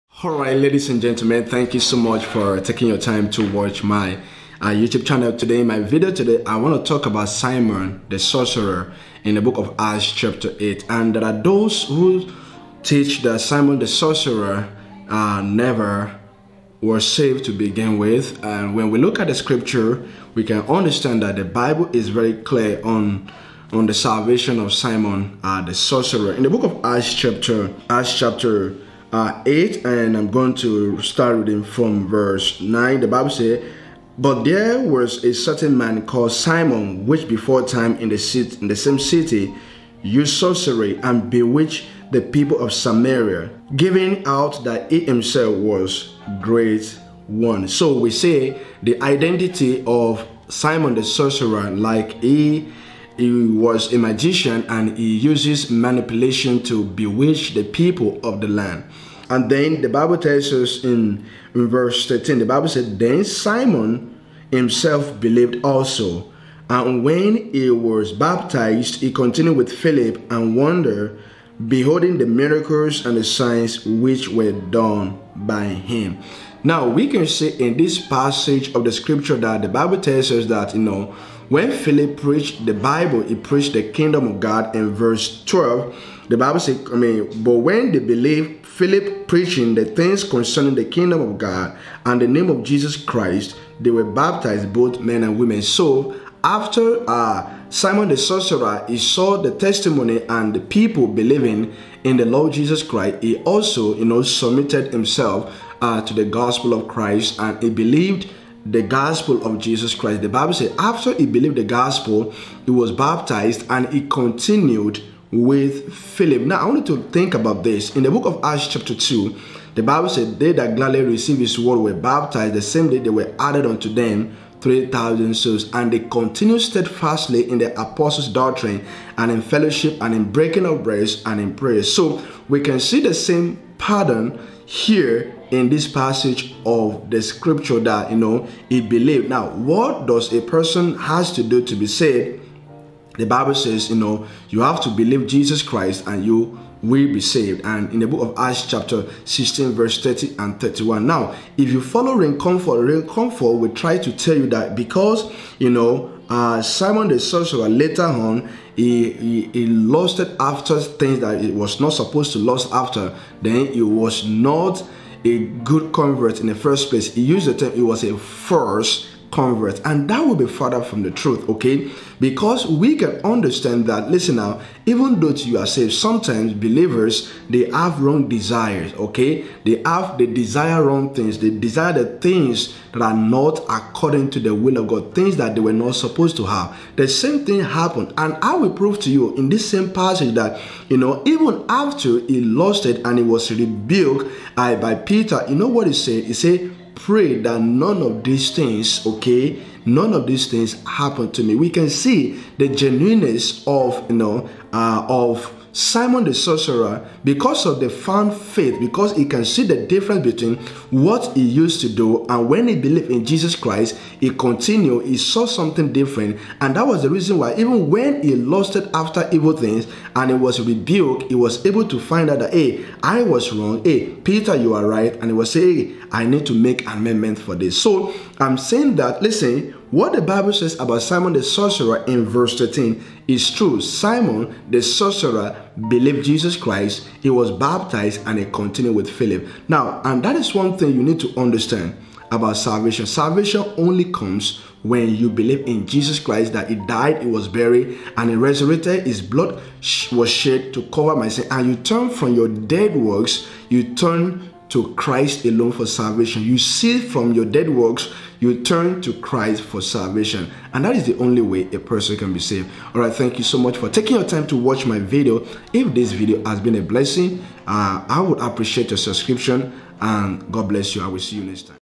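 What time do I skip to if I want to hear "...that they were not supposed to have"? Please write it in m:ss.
3:05.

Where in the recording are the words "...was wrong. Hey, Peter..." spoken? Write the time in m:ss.
3:43.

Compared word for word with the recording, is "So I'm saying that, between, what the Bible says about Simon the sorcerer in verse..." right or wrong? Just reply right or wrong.
wrong.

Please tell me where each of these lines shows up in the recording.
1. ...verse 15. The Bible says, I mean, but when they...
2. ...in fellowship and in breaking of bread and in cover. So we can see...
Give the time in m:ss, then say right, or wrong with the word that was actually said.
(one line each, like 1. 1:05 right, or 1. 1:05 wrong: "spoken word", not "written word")
1. 1:24 wrong: "12", not "15"
2. 2:09 wrong: "prayer", not "cover".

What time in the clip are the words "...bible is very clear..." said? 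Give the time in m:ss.
0:21.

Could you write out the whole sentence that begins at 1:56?
Now, I want you to think about this.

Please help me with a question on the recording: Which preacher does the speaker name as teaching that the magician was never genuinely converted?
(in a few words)
Ray Comfort.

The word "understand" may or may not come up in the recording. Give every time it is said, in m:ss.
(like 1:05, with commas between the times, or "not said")
0:20, 2:53, 4:01.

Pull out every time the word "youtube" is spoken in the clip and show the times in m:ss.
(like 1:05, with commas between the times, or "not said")
0:04.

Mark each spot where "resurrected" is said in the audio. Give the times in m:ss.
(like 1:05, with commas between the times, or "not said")
4:08.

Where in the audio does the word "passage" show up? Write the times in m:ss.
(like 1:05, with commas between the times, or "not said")
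1:18, 2:15, 3:09.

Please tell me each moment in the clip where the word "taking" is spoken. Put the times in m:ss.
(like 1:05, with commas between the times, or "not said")
0:02, 4:23.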